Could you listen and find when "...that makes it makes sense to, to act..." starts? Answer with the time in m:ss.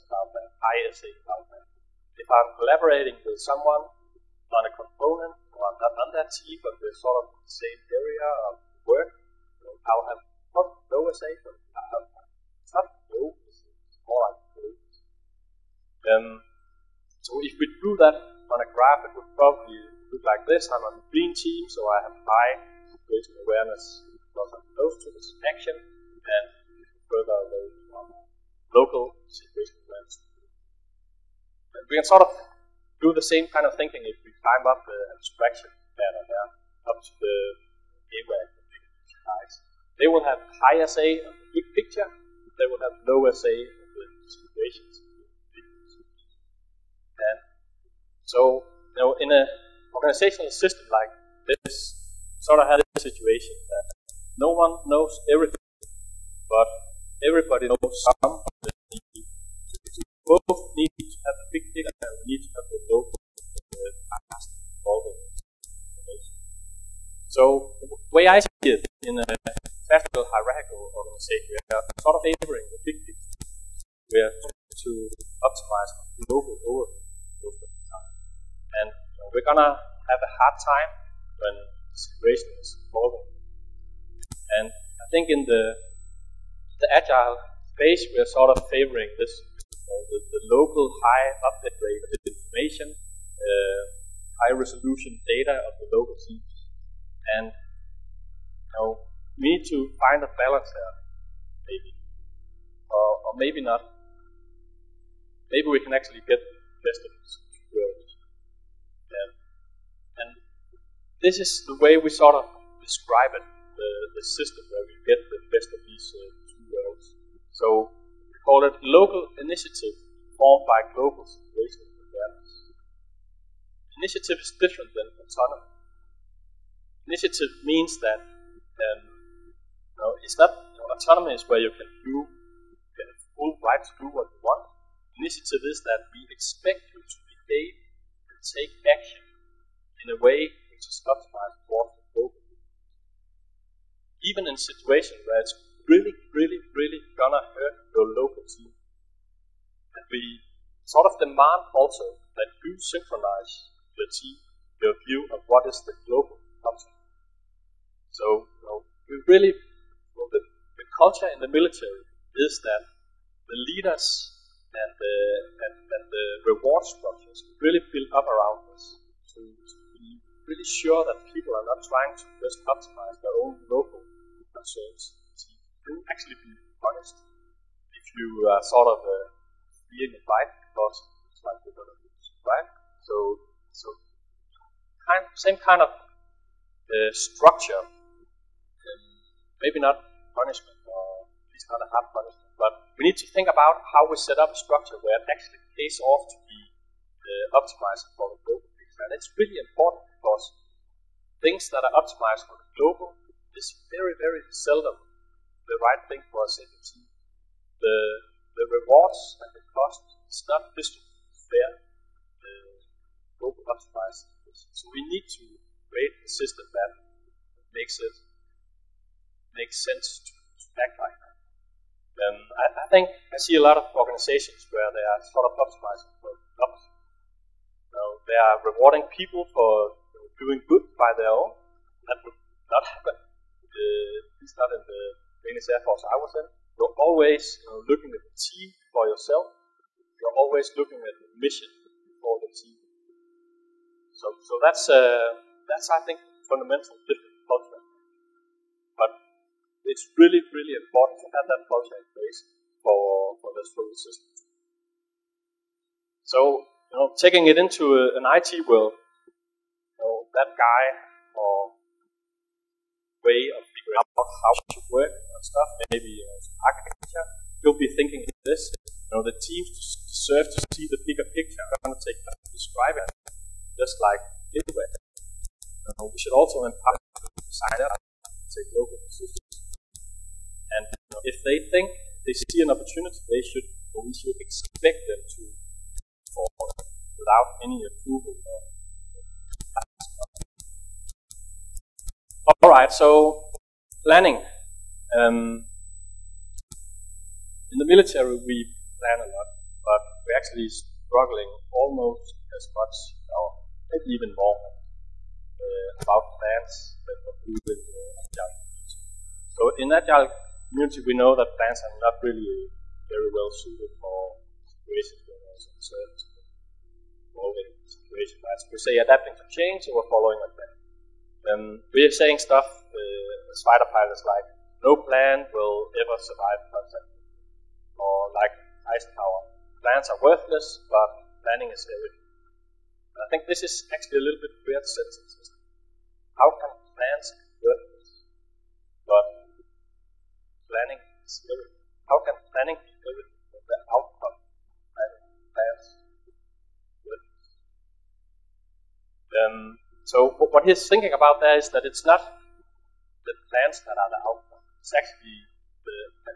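3:36.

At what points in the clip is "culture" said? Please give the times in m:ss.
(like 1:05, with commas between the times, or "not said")
2:41, 4:07.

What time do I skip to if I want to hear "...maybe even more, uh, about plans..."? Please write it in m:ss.
5:03.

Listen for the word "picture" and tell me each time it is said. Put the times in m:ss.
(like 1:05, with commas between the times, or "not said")
0:41, 1:13, 3:18, 4:31.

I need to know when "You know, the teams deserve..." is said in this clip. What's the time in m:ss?
4:29.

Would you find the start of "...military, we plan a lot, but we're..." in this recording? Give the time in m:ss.
4:57.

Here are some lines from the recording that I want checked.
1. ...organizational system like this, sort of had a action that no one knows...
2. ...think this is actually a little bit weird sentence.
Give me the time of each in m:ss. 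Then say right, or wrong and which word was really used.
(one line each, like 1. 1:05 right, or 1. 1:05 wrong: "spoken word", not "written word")
1. 0:49 wrong: "situation", not "action"
2. 5:33 right.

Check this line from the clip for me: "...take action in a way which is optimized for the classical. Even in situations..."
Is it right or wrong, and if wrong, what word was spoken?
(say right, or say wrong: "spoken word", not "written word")
wrong: "global", not "classical".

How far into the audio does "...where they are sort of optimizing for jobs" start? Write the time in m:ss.
3:44.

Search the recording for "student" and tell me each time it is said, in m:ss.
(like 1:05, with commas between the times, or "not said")
4:13.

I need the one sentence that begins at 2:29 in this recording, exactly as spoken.
And we sort of demand also that you synchronize your team, your view of what is the global function.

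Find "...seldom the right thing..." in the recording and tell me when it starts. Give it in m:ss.
3:24.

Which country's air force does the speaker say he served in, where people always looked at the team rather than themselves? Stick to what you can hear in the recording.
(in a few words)
Danish.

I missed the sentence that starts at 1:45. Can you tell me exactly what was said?
Maybe we can actually get the best of two worlds.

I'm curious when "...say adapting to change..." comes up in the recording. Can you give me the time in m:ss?
5:18.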